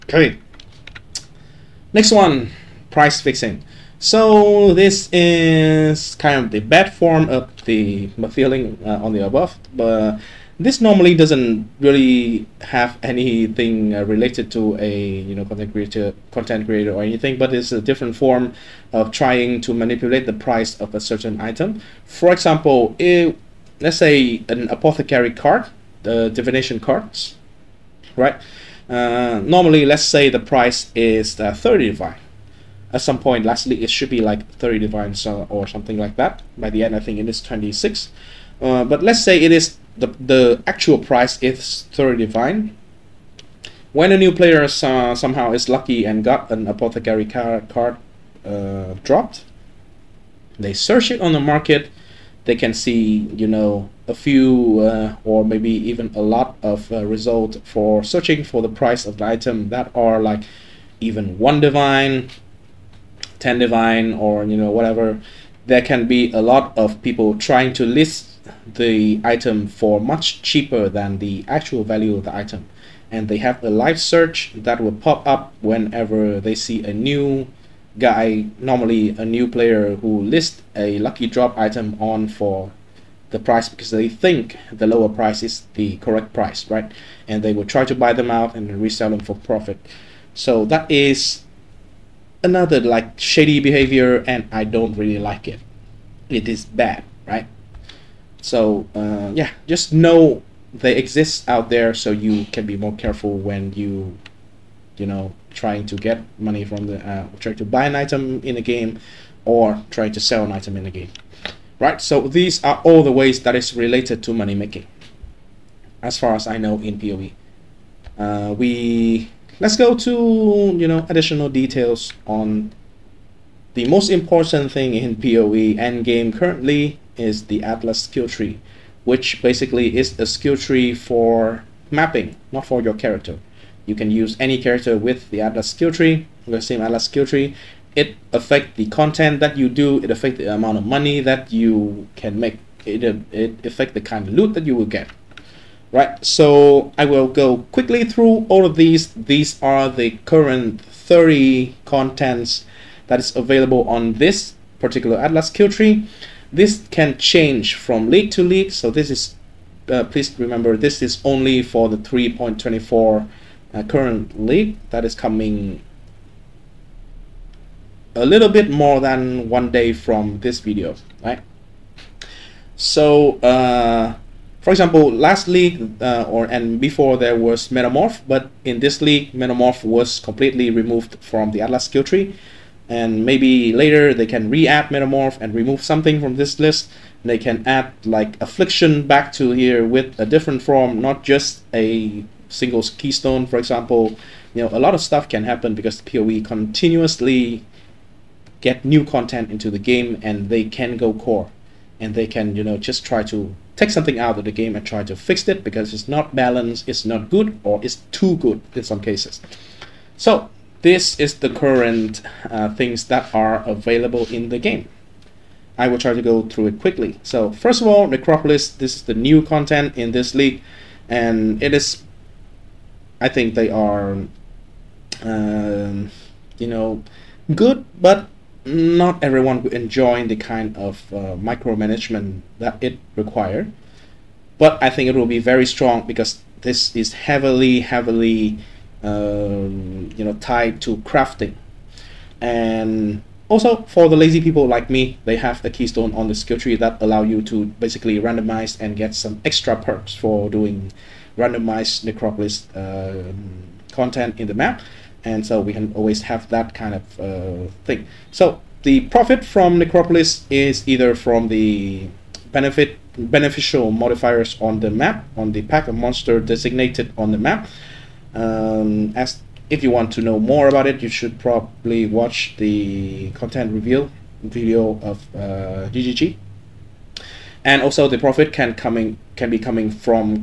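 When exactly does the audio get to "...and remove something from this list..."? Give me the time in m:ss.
3:05.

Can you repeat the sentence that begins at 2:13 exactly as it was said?
You can use any character with the Atlas skill tree, the same Atlas skill tree.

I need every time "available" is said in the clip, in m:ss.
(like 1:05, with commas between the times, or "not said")
2:33, 3:33.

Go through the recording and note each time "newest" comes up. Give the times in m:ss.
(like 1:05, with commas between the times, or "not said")
not said.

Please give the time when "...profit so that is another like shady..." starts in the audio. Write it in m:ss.
1:29.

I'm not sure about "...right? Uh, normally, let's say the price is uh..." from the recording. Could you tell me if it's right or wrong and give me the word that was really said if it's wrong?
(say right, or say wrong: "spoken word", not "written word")
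right.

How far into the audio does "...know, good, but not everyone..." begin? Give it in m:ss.
3:46.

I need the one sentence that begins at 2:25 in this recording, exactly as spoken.
Right, so I will go quickly through all of these.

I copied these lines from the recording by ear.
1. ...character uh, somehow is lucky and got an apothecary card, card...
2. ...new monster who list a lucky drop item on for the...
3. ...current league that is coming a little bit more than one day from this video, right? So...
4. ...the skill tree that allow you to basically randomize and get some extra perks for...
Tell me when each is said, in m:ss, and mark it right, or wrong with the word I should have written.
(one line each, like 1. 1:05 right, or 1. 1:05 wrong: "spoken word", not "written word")
1. 0:44 wrong: "player", not "character"
2. 1:19 wrong: "player", not "monster"
3. 2:43 right
4. 4:06 right.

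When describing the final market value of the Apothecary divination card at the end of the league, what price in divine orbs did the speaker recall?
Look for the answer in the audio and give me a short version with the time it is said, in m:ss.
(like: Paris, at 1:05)
26, at 0:37.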